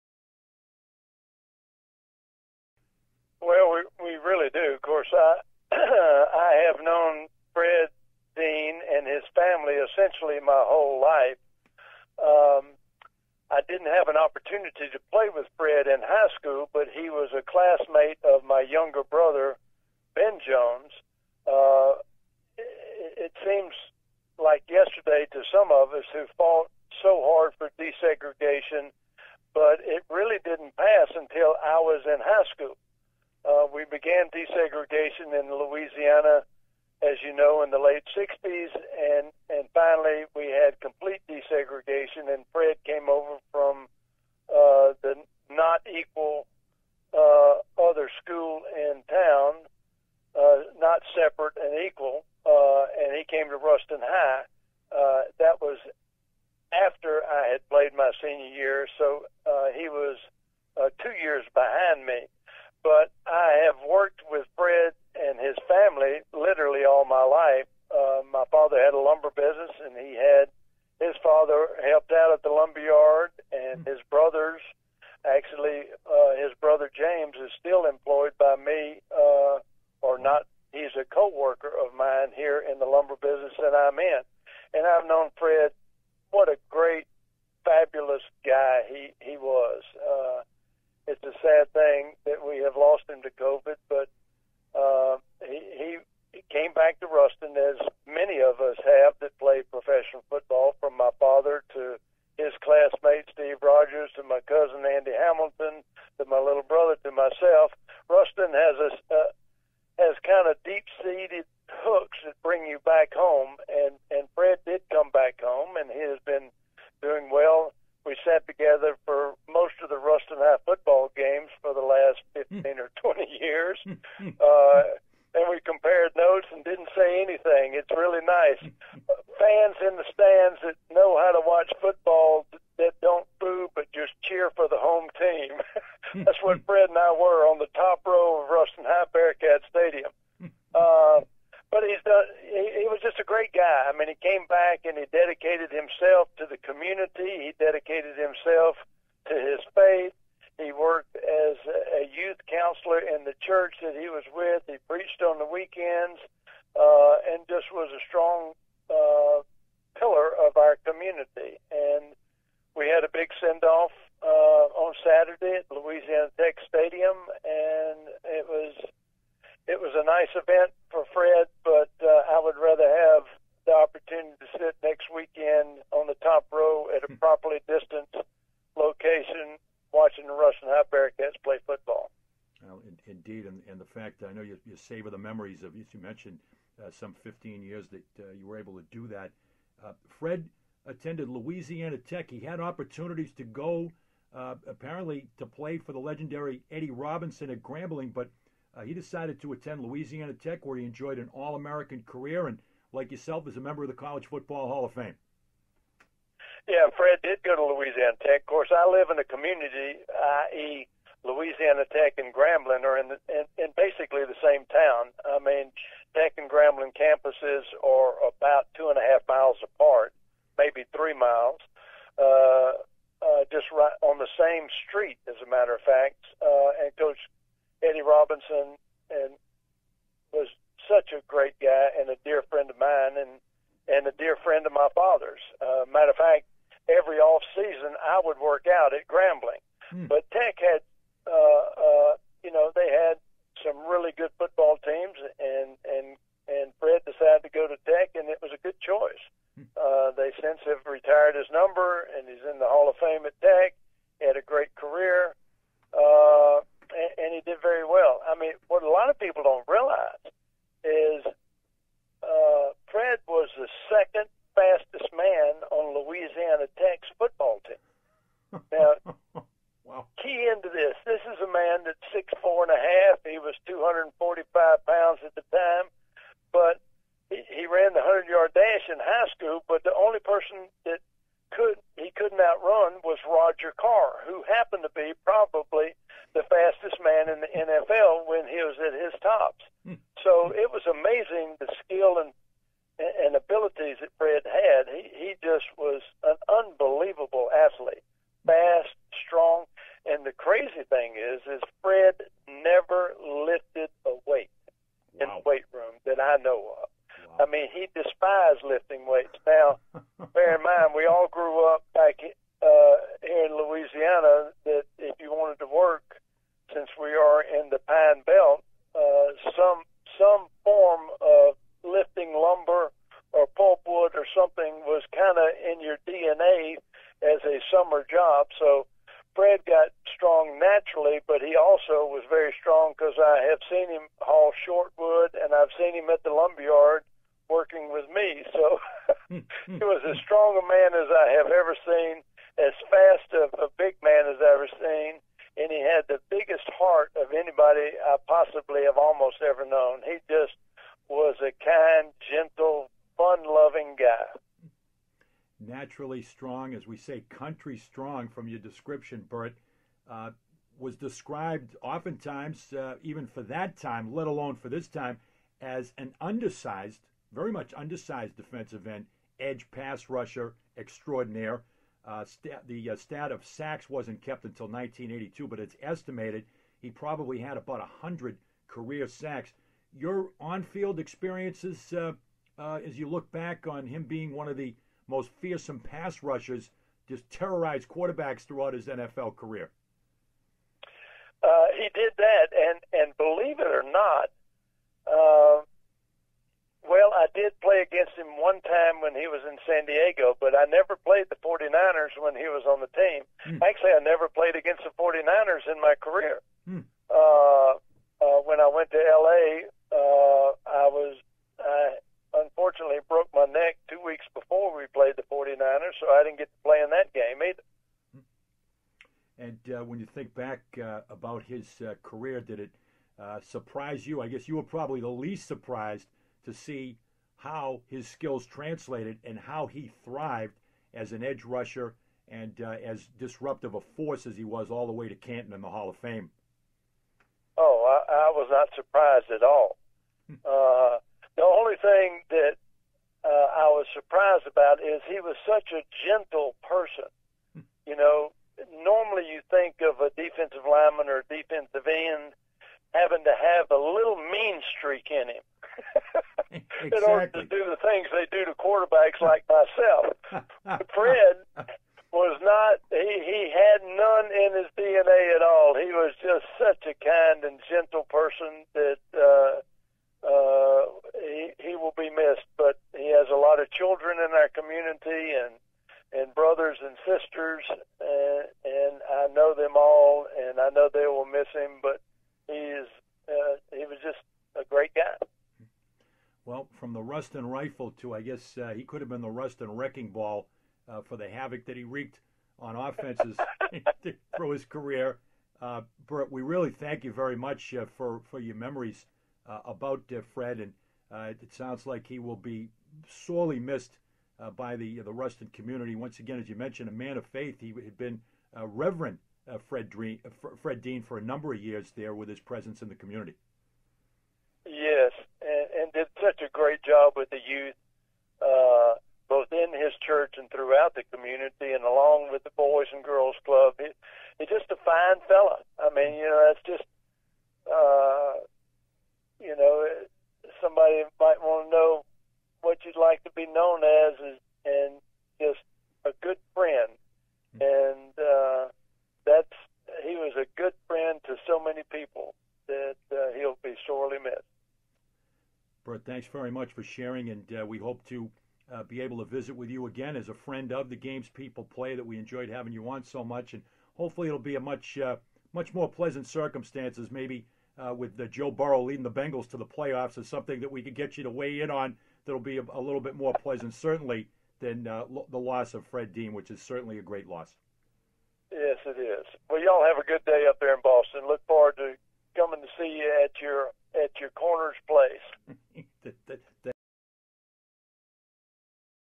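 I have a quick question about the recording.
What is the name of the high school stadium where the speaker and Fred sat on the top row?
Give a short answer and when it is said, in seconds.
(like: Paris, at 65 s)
Ruston High Bearcat Stadium, at 138 s.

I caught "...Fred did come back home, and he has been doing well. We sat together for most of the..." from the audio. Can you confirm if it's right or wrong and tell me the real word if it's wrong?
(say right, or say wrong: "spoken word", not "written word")
right.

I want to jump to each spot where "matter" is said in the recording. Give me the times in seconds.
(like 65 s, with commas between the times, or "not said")
225 s, 235 s.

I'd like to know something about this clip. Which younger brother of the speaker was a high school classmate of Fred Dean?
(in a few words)
Ben Jones.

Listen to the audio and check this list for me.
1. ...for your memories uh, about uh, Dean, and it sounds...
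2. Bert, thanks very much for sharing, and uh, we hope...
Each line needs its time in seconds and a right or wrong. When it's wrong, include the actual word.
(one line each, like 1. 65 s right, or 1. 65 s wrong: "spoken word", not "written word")
1. 498 s wrong: "Fred", not "Dean"
2. 545 s right.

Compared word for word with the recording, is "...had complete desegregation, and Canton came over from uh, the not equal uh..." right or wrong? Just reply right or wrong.
wrong.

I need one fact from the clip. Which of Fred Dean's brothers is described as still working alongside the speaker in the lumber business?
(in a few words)
James.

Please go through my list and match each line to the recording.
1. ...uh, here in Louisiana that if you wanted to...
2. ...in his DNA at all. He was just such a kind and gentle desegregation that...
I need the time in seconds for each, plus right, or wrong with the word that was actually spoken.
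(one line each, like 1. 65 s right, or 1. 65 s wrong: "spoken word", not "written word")
1. 312 s right
2. 464 s wrong: "person", not "desegregation".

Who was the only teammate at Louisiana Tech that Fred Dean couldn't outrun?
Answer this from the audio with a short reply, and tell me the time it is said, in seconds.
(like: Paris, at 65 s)
Roger Carr, at 283 s.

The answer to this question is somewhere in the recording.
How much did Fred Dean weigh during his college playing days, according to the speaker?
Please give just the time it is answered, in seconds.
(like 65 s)
273 s.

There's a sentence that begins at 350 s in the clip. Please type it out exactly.
He just was a kind, gentle, fun-loving guy.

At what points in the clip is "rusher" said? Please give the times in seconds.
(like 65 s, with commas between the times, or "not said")
370 s, 386 s, 431 s.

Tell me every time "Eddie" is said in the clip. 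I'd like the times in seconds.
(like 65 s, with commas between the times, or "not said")
196 s, 227 s.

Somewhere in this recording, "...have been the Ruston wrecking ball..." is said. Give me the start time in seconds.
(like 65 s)
489 s.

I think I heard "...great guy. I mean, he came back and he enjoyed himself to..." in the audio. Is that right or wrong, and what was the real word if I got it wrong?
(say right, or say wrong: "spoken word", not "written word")
wrong: "dedicated", not "enjoyed".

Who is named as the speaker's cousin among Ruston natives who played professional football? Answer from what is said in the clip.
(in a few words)
Andy Hamilton.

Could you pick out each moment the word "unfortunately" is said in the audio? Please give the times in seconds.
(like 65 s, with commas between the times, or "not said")
412 s.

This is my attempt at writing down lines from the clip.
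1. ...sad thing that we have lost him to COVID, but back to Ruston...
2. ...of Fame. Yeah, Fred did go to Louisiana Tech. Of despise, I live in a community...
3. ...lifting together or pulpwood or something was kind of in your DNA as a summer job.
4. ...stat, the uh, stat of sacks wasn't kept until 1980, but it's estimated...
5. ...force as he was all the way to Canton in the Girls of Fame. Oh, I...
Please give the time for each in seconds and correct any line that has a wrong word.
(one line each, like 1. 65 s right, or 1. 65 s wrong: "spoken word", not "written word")
1. 91 s right
2. 204 s wrong: "course", not "despise"
3. 321 s wrong: "lumber", not "together"
4. 372 s wrong: "1982", not "1980"
5. 433 s wrong: "Hall", not "Girls".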